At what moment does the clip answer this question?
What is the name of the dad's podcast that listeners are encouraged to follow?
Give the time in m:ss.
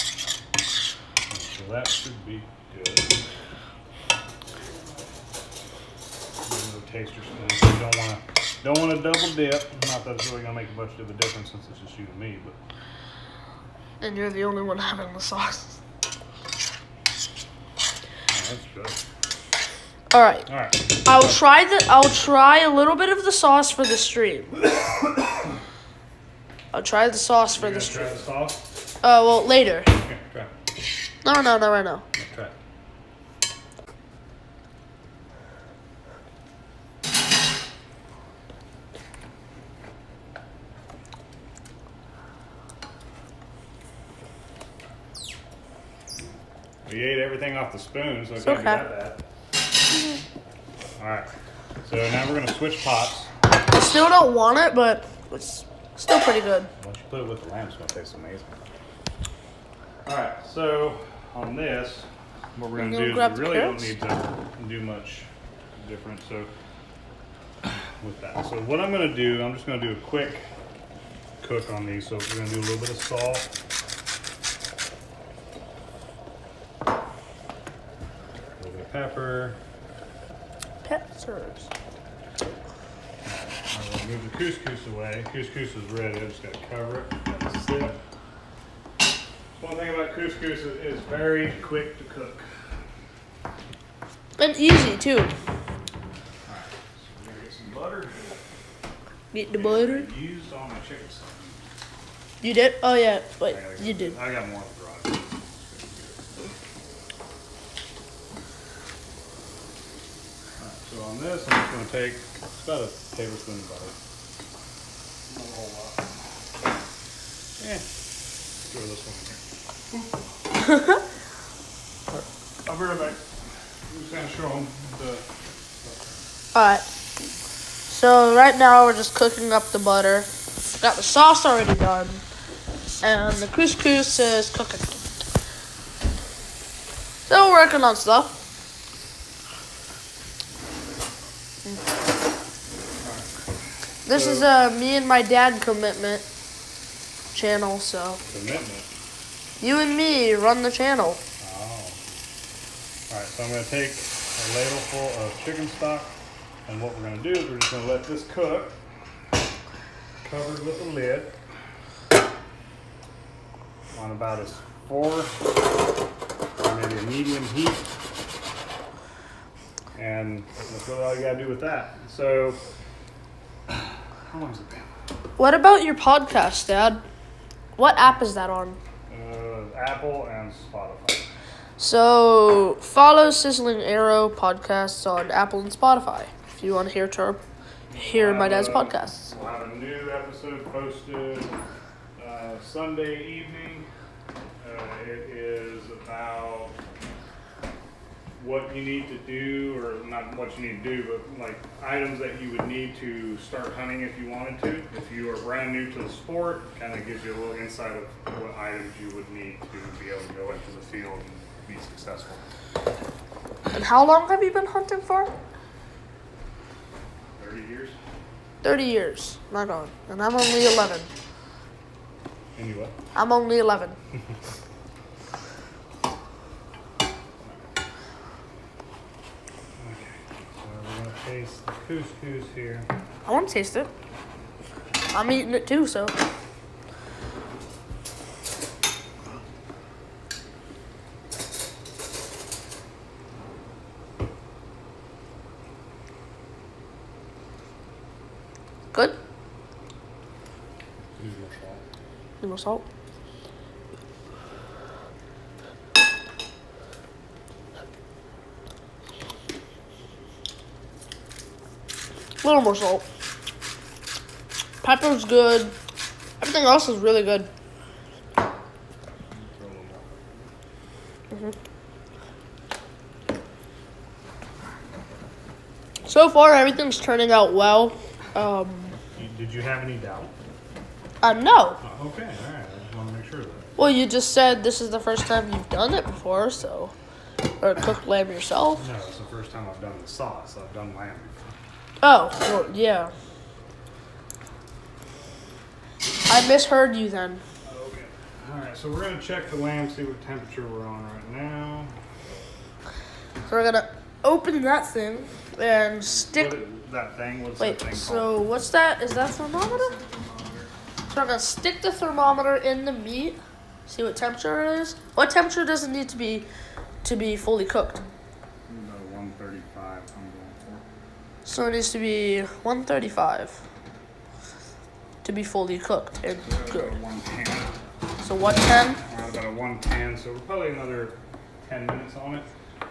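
3:03.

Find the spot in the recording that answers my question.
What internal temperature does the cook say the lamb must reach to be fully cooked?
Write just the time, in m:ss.
5:22.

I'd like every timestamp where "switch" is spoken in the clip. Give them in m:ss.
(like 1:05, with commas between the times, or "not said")
0:52.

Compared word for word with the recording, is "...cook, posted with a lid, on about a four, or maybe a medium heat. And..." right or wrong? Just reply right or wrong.
wrong.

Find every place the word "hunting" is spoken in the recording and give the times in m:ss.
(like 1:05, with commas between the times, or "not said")
3:23, 3:34.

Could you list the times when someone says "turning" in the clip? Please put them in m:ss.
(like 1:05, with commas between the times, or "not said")
4:36.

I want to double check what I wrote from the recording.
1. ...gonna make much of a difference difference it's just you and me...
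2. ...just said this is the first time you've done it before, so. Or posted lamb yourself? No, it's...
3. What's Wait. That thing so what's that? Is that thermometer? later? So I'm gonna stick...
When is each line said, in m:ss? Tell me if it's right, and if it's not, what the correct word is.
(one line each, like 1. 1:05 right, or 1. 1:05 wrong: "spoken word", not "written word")
1. 0:10 wrong: "since", not "difference"
2. 4:44 wrong: "cooked", not "posted"
3. 5:07 wrong: "thermometer", not "later".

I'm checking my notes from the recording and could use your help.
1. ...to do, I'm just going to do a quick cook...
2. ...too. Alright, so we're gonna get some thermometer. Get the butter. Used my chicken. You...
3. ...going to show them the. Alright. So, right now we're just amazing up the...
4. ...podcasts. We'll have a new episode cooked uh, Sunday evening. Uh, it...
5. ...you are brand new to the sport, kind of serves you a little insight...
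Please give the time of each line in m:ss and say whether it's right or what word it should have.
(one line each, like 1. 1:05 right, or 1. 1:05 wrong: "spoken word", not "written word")
1. 1:09 right
2. 1:34 wrong: "butter", not "thermometer"
3. 2:04 wrong: "cooking", not "amazing"
4. 3:08 wrong: "posted", not "cooked"
5. 3:25 wrong: "gives", not "serves".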